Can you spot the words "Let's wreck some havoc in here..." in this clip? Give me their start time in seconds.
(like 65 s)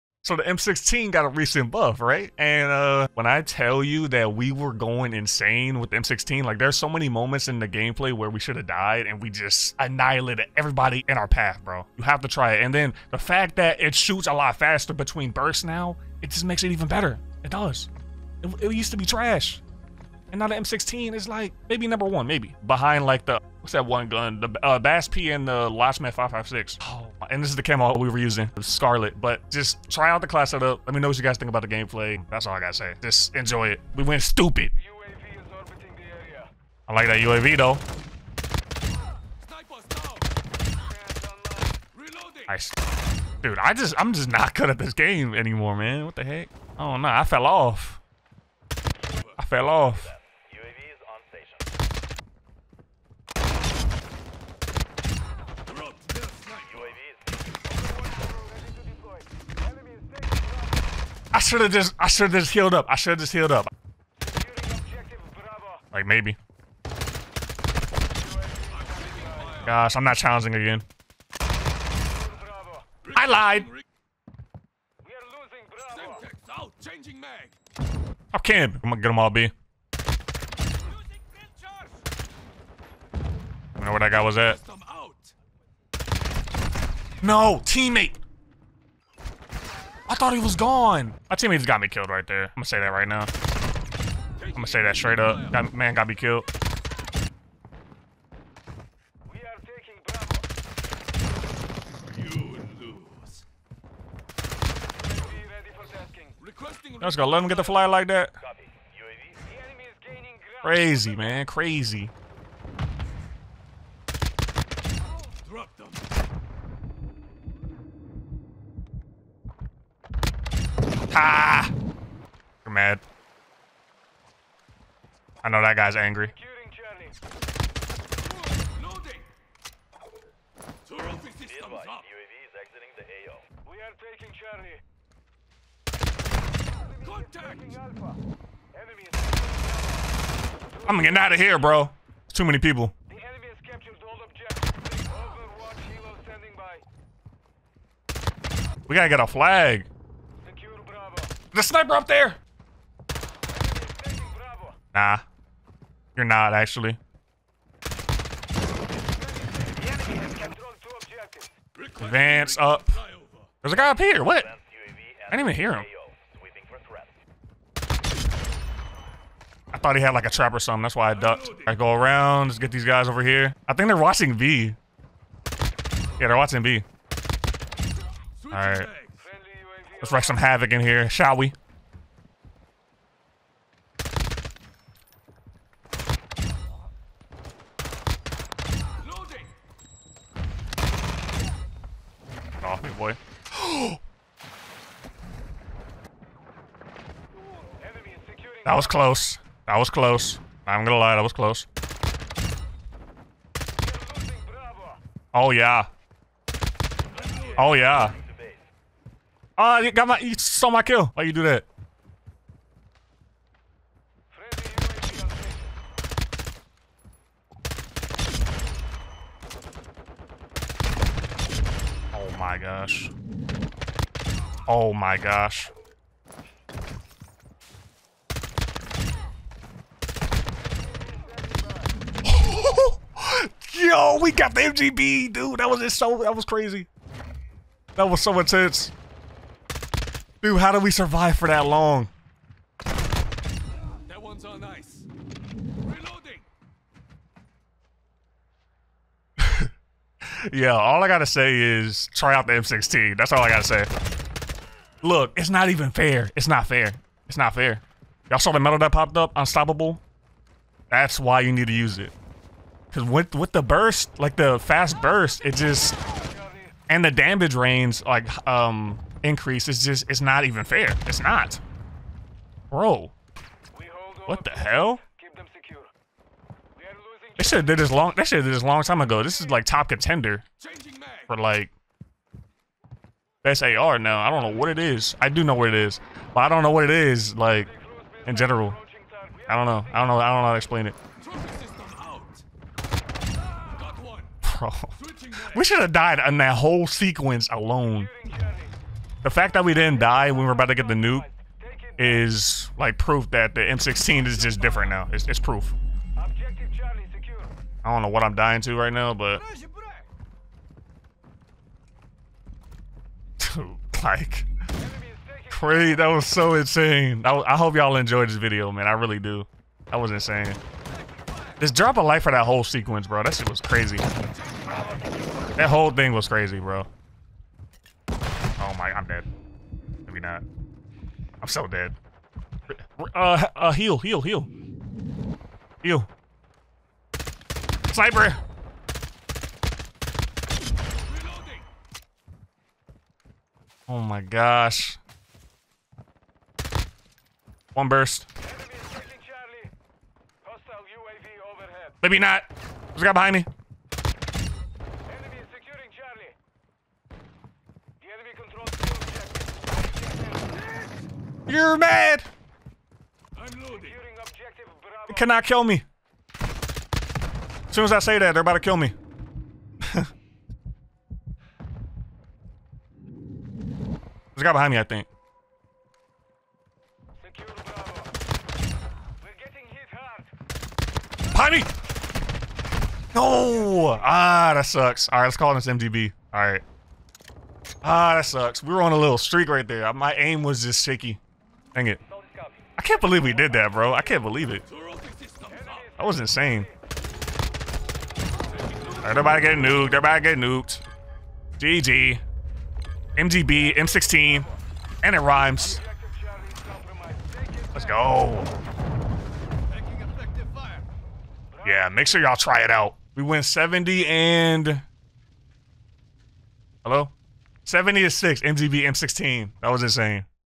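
180 s.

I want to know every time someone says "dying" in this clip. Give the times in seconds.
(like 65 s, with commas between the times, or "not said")
308 s.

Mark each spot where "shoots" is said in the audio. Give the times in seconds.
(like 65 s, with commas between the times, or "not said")
13 s.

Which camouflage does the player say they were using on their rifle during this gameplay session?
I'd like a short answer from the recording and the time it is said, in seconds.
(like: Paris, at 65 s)
Scarlet, at 28 s.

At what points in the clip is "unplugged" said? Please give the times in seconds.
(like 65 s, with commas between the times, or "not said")
not said.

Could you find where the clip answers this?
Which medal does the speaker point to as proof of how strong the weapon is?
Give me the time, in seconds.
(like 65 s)
259 s.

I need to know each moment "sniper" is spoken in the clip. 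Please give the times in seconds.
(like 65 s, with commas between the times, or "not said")
151 s, 337 s.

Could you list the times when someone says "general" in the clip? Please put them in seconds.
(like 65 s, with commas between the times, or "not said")
288 s.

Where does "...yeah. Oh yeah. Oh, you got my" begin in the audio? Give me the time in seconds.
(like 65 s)
205 s.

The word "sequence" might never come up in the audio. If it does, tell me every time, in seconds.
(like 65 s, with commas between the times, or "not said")
296 s, 322 s.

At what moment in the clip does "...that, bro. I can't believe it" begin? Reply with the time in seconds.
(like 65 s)
393 s.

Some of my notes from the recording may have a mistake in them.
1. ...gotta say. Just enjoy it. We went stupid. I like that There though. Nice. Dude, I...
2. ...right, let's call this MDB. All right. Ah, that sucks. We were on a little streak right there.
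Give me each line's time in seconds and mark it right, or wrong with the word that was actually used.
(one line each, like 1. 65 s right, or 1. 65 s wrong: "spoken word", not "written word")
1. 32 s wrong: "UAV", not "There"
2. 385 s right.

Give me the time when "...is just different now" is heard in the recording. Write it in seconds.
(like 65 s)
304 s.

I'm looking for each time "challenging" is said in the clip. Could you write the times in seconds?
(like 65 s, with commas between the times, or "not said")
70 s.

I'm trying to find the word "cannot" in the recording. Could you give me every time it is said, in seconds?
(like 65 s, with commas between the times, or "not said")
365 s.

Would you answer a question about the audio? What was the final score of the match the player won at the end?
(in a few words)
70 to 6.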